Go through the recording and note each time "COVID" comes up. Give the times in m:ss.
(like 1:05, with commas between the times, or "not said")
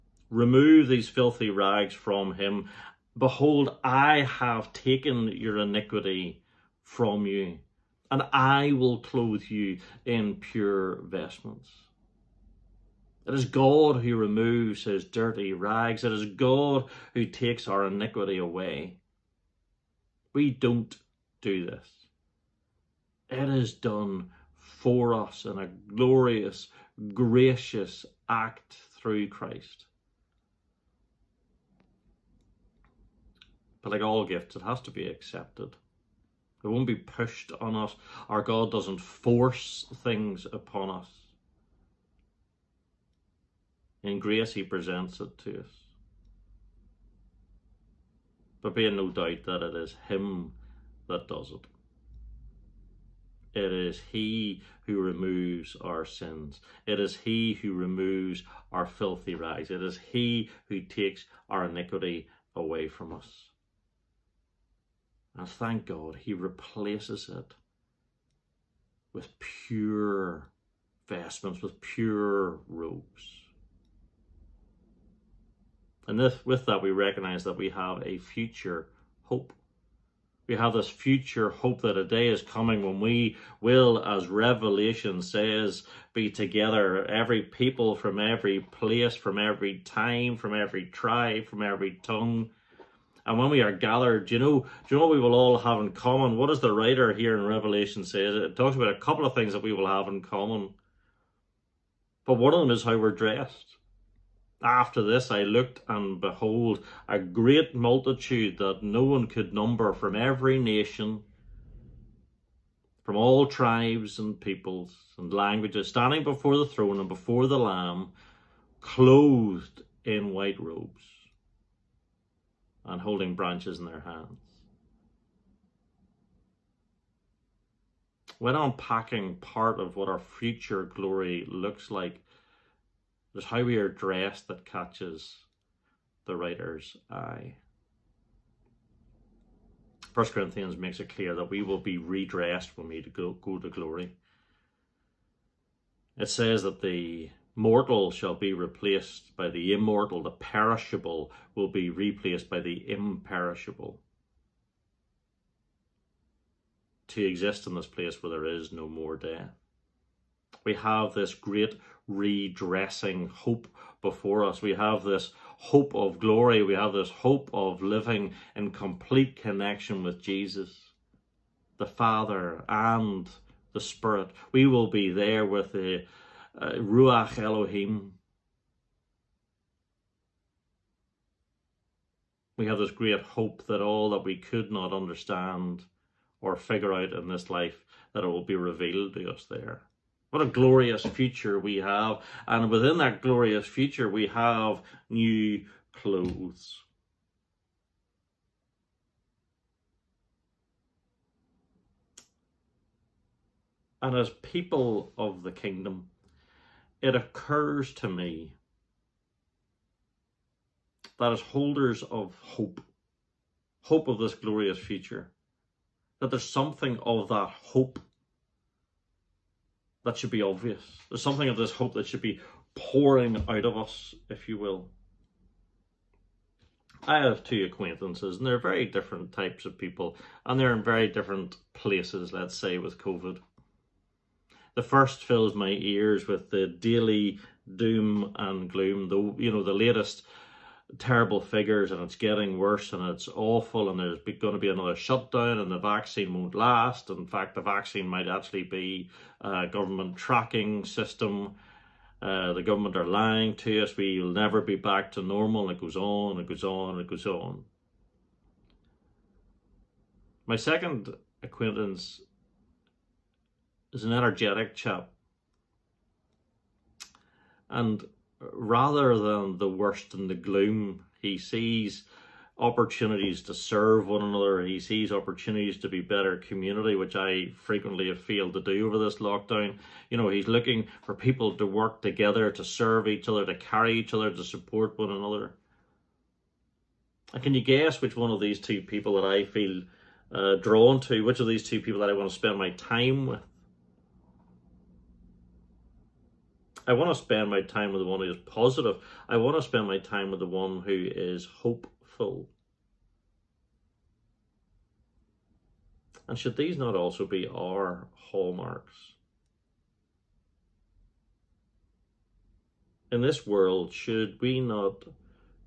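3:52.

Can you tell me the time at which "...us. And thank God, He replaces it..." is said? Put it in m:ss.
1:03.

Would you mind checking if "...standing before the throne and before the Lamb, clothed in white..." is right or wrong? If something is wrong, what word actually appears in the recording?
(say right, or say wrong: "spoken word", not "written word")
right.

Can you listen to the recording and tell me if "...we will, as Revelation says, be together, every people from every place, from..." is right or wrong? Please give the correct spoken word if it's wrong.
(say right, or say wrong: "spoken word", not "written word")
right.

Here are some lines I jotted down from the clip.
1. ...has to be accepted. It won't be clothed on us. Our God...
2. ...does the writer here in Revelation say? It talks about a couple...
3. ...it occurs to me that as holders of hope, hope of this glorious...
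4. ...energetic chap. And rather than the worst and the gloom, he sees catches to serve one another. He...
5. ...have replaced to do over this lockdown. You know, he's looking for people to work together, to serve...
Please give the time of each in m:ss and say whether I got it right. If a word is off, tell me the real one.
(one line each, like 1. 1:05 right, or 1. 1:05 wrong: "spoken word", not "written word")
1. 0:34 wrong: "pushed", not "clothed"
2. 1:36 right
3. 3:27 right
4. 4:24 wrong: "opportunities", not "catches"
5. 4:38 wrong: "failed", not "replaced".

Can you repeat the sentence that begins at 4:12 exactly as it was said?
Uh, the government are lying to us.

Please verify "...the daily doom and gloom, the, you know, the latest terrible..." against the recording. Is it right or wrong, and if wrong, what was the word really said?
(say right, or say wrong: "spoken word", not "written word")
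right.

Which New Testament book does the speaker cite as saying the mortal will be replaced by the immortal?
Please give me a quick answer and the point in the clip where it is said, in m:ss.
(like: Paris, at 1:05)
First Corinthians, at 2:20.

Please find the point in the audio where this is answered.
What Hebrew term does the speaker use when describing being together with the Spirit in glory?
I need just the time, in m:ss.
2:56.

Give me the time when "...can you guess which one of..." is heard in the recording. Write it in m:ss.
4:47.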